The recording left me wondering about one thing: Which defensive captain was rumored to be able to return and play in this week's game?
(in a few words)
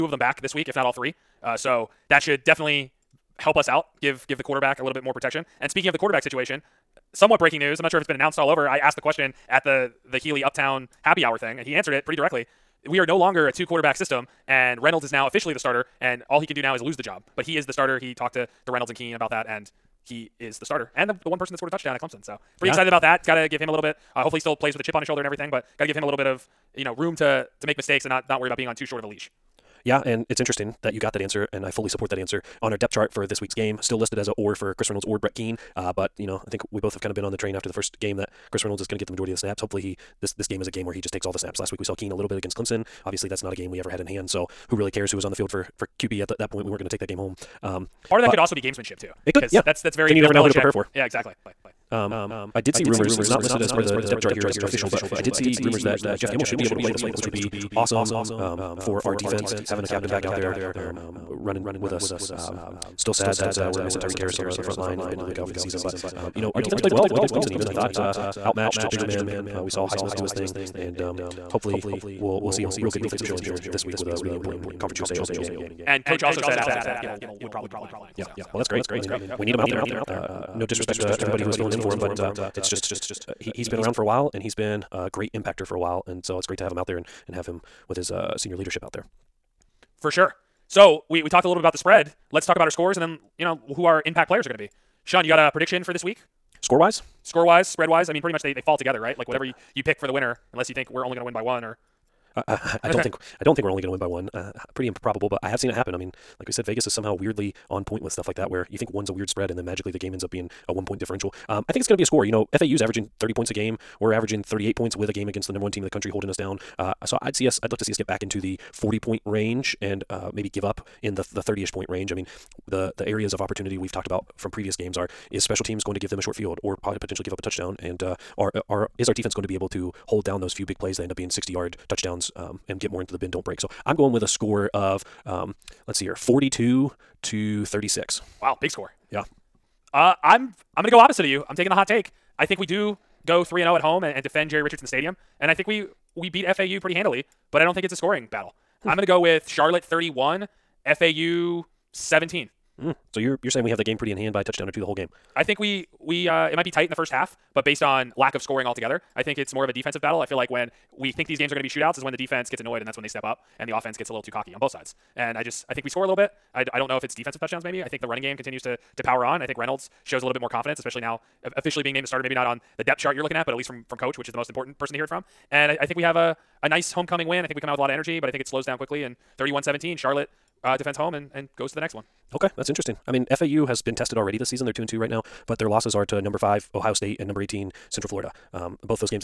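Jeff Gemmell.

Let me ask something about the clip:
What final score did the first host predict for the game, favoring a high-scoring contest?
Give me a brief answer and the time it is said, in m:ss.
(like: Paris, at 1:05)
42 to 36, at 2:16.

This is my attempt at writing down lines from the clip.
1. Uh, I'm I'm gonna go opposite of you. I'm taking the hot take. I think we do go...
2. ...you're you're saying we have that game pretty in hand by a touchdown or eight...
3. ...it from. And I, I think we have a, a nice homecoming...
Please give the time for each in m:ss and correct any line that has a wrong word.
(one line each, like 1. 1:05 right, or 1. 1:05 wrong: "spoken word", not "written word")
1. 2:19 right
2. 2:33 wrong: "two", not "eight"
3. 2:55 right.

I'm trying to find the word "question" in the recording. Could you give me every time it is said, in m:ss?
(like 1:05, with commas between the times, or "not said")
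0:08.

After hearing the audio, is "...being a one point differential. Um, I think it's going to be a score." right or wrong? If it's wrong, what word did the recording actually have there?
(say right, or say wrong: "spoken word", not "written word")
right.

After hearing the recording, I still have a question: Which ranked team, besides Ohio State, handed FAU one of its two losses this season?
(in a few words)
Central Florida.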